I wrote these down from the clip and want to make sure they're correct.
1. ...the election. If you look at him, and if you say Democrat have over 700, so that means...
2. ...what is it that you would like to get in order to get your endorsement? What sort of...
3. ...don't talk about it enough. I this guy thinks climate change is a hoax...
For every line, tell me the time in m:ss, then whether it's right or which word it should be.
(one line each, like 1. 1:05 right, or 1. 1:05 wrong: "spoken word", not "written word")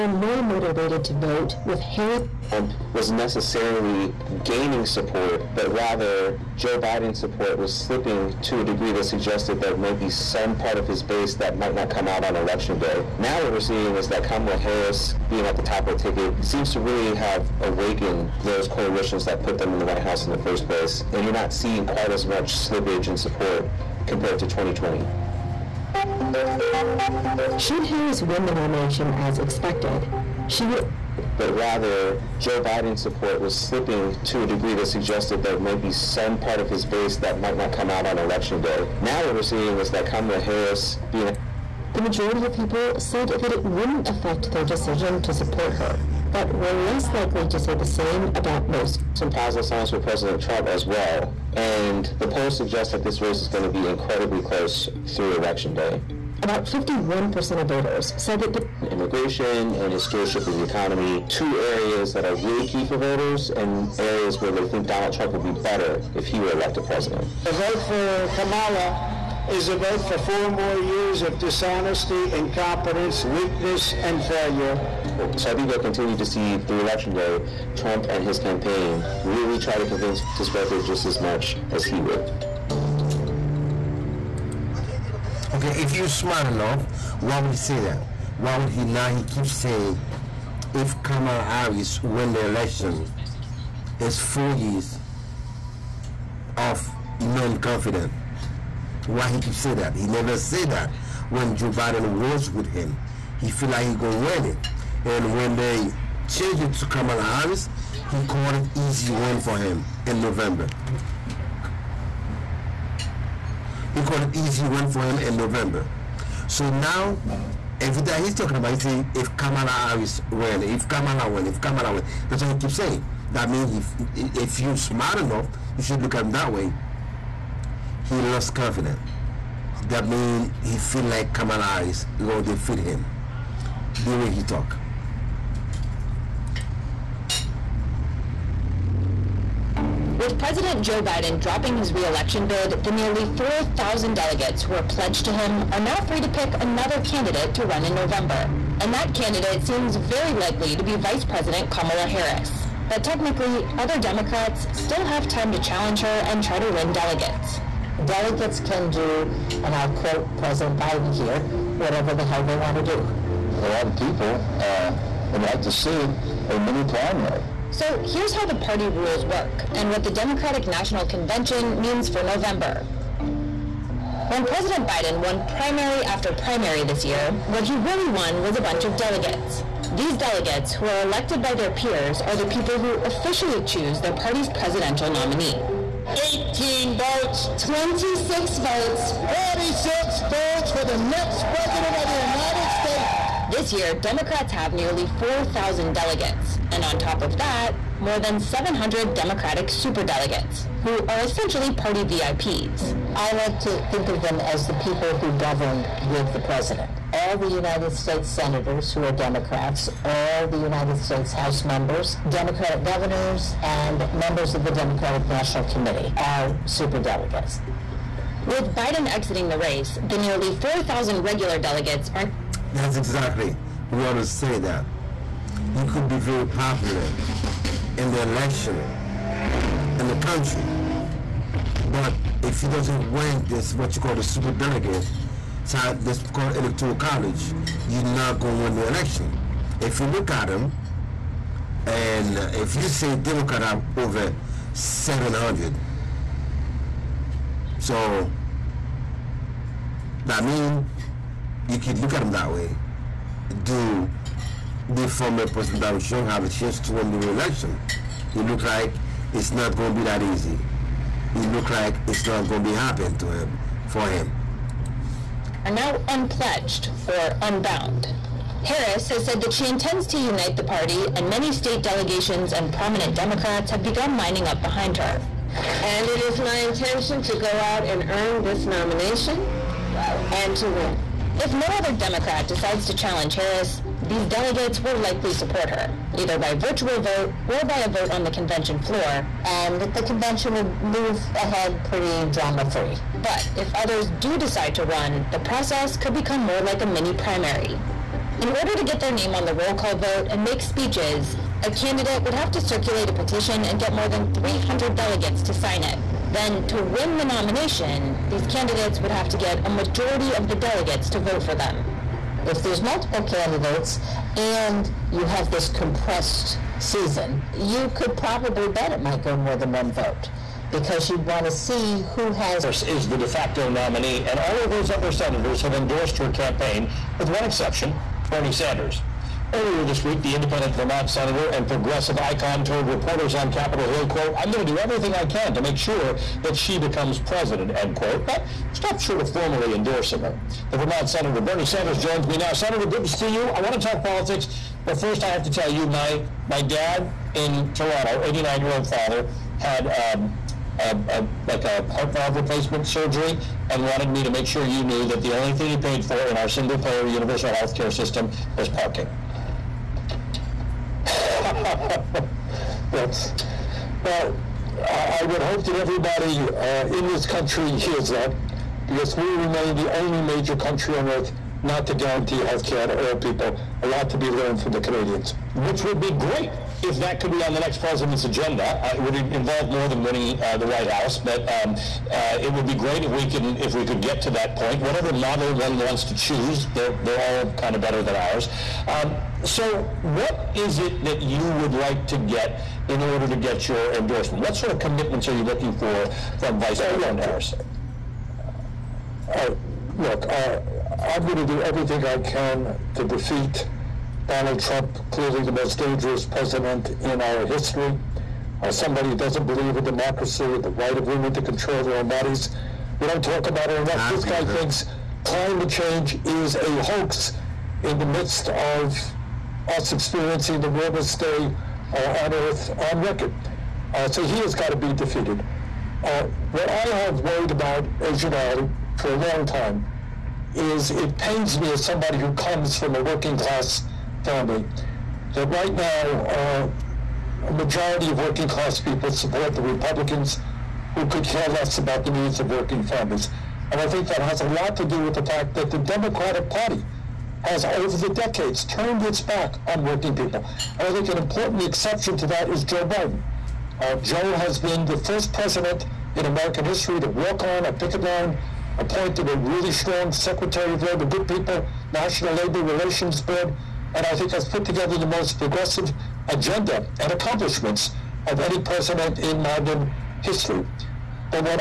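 1. 3:58 right
2. 6:30 right
3. 6:53 right.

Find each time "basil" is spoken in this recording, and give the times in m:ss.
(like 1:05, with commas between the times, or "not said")
not said.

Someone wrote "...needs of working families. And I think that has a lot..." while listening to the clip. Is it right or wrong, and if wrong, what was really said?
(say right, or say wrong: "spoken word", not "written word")
right.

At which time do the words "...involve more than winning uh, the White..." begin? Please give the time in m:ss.
6:19.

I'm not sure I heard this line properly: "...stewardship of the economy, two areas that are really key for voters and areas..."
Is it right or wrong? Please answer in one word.
right.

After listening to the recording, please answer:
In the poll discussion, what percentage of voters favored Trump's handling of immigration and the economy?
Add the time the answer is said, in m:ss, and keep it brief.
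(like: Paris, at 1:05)
51%, at 0:56.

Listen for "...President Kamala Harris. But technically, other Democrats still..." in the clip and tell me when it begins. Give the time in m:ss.
2:31.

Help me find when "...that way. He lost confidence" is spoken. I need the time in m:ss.
2:06.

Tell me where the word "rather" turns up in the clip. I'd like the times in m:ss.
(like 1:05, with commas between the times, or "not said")
0:05, 0:31.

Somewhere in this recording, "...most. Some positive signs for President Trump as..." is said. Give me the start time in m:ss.
0:48.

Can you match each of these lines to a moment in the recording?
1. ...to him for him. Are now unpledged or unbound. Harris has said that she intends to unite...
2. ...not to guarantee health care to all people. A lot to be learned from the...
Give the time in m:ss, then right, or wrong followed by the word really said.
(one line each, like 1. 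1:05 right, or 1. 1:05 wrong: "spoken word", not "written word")
1. 4:23 right
2. 6:11 right.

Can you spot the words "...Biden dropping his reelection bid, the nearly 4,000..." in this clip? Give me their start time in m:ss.
2:21.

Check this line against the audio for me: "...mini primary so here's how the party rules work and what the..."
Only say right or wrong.
right.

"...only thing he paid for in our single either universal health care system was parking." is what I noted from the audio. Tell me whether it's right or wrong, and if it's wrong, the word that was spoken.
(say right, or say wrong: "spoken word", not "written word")
wrong: "payer", not "either".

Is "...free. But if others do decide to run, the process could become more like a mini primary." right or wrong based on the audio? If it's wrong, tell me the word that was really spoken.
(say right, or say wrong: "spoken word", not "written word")
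right.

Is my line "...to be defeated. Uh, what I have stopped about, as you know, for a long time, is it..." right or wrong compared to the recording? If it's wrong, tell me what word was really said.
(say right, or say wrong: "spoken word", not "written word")
wrong: "worried", not "stopped".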